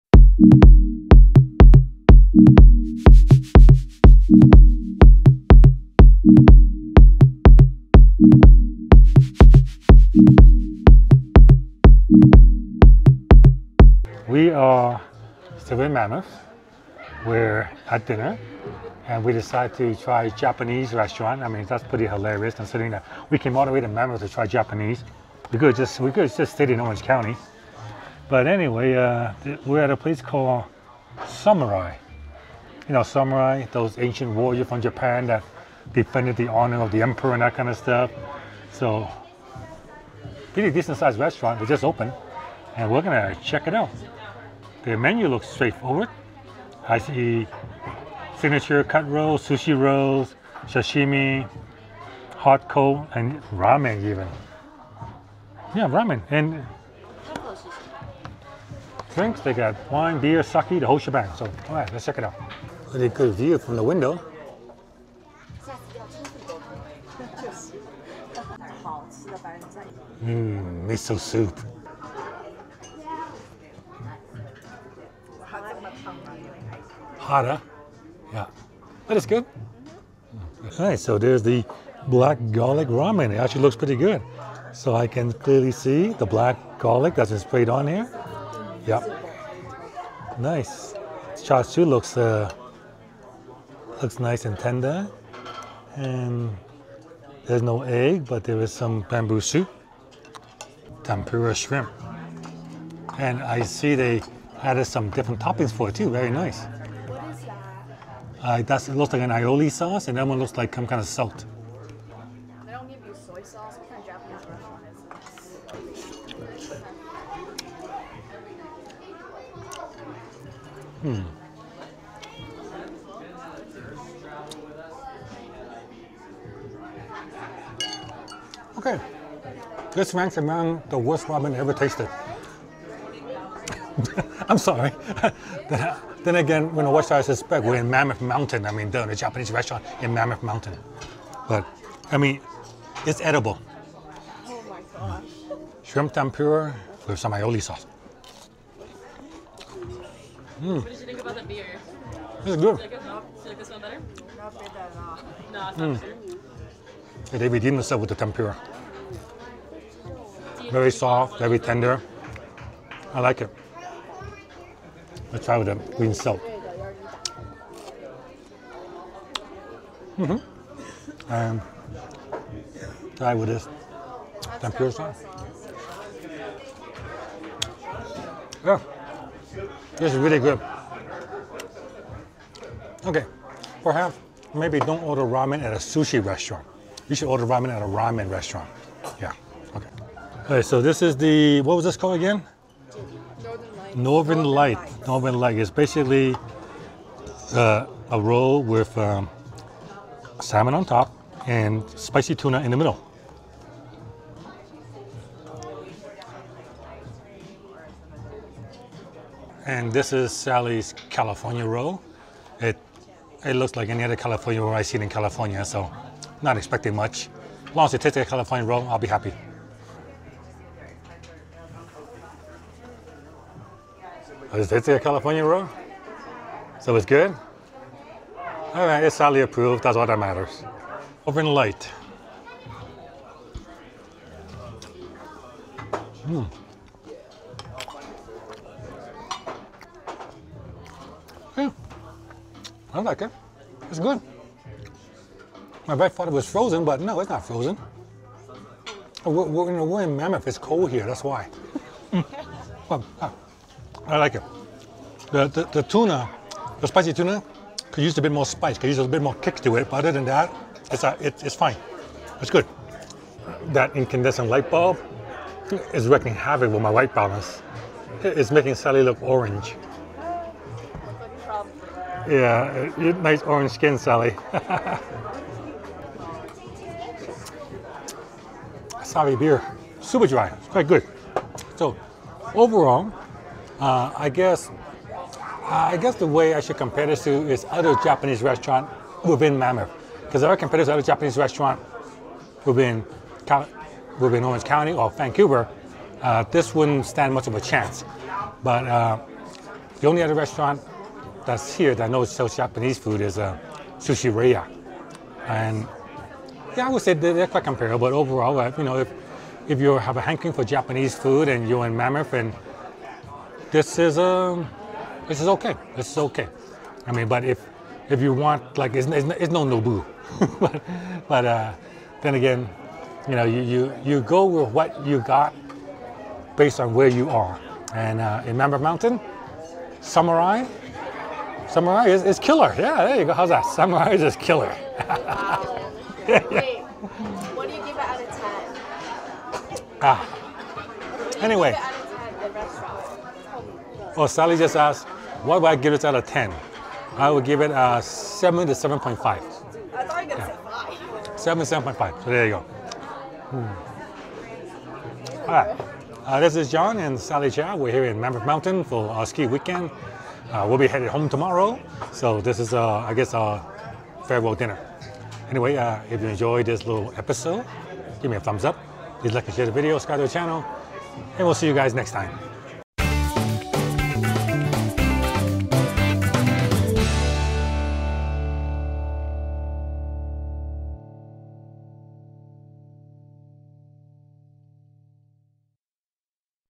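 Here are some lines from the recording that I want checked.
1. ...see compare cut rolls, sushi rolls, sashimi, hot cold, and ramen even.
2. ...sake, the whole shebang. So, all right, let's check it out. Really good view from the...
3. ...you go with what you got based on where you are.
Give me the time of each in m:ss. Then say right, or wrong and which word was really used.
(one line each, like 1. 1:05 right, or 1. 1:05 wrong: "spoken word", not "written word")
1. 0:46 wrong: "signature", not "compare"
2. 1:00 right
3. 5:24 right.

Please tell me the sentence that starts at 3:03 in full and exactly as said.
Okay, perhaps maybe don't order ramen at a sushi restaurant.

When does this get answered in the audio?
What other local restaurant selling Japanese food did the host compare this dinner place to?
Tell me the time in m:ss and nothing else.
5:03.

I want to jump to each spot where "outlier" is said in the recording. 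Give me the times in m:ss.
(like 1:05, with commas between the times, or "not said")
not said.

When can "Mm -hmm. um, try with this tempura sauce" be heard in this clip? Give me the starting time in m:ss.
2:50.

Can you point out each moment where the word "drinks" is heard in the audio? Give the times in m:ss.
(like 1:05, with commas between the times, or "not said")
0:59.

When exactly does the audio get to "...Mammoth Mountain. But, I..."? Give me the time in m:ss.
2:20.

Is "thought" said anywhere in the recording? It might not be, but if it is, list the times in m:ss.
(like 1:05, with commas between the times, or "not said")
4:06, 5:50.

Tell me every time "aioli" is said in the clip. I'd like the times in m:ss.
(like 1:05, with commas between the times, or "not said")
1:49, 2:27.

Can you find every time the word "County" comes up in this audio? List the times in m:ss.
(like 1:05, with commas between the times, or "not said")
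0:27, 4:54.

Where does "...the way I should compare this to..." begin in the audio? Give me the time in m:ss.
4:46.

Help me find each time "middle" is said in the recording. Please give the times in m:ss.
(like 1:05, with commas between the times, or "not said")
3:22.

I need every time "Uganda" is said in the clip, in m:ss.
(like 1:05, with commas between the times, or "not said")
not said.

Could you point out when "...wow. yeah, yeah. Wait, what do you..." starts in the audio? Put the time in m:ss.
5:35.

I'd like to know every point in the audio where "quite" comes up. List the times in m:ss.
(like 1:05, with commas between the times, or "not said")
4:40, 5:07.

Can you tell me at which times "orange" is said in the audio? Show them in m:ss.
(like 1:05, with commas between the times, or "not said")
0:26, 4:29, 4:33, 4:54.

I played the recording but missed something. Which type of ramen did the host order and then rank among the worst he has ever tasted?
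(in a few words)
Black garlic ramen.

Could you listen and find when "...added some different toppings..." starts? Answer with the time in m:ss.
1:44.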